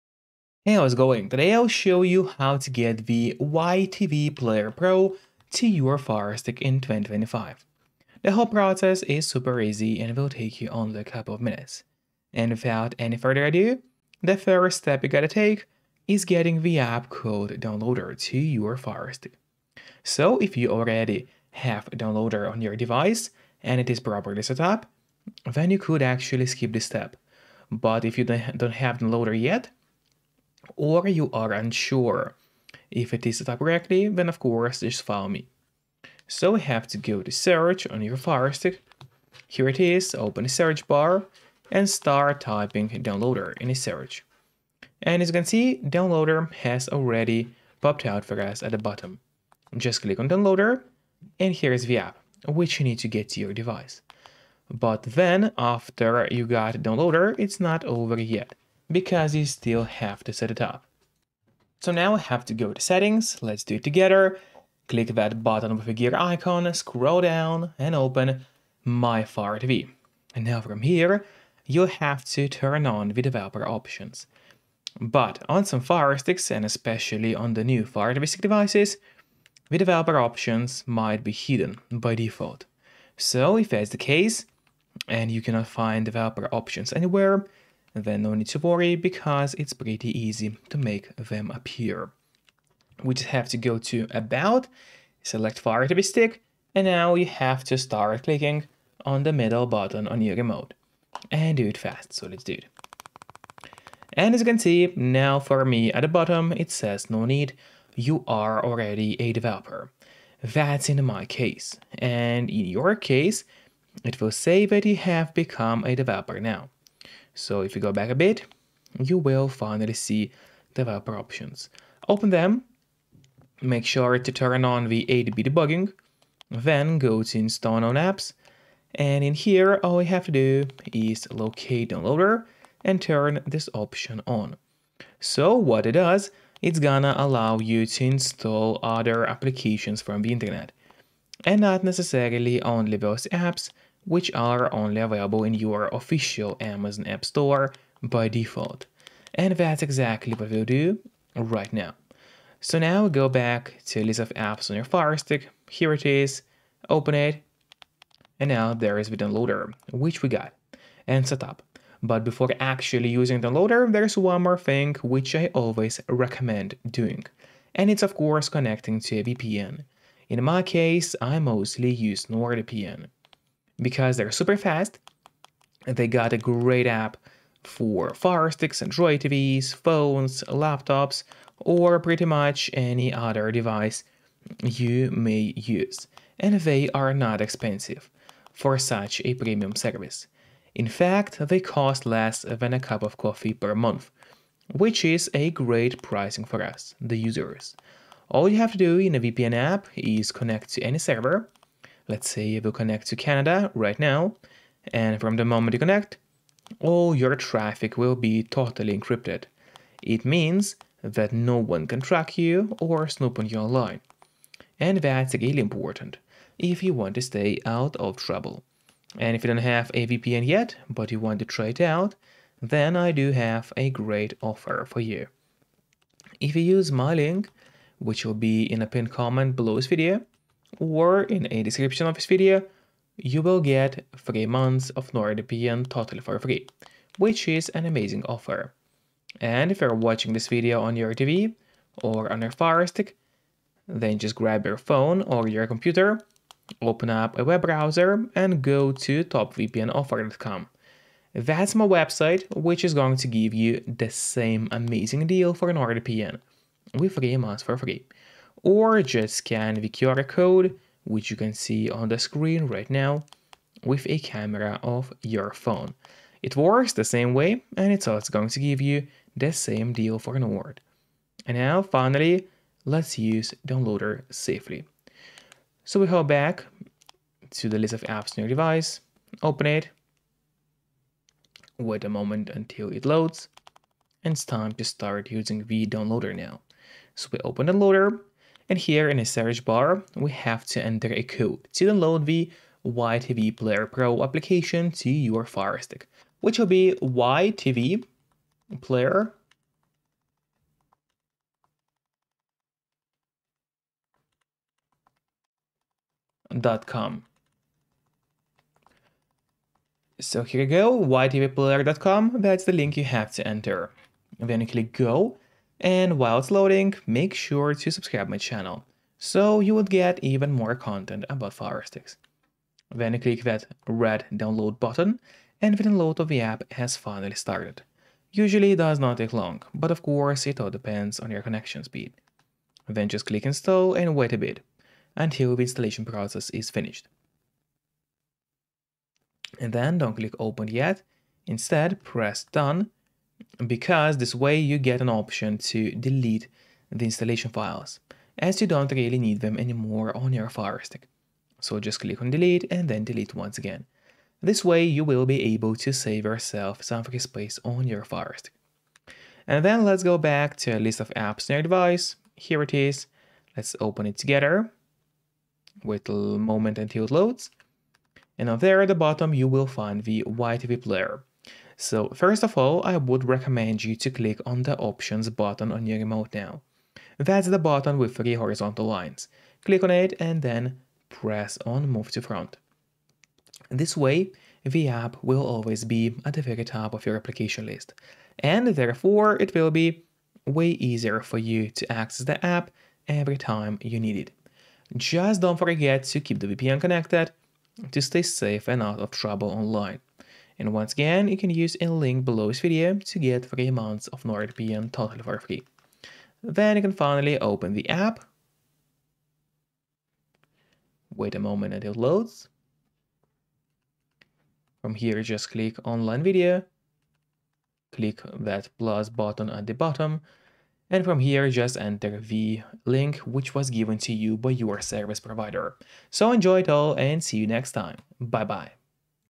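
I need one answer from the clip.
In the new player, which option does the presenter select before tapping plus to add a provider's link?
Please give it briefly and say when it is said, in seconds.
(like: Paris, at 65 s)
online video, at 415 s.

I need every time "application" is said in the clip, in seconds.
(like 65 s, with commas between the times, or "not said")
139 s, 294 s, 387 s.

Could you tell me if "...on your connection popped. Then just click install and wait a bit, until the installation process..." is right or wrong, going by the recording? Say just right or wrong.
wrong.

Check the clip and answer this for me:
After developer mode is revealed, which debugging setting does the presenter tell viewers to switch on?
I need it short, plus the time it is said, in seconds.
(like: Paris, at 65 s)
ADB debugging, at 125 s.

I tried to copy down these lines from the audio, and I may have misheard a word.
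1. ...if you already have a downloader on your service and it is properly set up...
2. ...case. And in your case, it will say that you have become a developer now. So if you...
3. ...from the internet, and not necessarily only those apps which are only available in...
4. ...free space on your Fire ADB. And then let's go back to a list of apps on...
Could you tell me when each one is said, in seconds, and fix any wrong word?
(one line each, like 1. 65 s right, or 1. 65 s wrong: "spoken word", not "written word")
1. 20 s wrong: "device", not "service"
2. 111 s right
3. 140 s right
4. 357 s wrong: "Stick", not "ADB".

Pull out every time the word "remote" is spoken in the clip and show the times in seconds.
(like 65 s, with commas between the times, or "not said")
100 s, 375 s.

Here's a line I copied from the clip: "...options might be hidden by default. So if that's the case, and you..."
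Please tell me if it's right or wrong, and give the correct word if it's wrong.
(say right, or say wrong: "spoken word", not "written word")
right.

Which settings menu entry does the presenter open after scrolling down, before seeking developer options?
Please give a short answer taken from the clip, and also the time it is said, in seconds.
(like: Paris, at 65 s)
My Fire TV, at 68 s.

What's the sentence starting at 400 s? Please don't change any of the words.
And once again, you can use a link below this video to get 3 months of NordVPN totally for free.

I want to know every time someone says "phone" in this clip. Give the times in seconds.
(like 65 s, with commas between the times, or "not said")
179 s, 244 s, 265 s.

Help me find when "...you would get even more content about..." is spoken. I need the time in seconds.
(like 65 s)
319 s.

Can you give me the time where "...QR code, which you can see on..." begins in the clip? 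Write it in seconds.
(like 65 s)
259 s.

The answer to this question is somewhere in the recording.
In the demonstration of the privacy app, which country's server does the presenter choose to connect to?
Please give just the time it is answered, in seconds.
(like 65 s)
203 s.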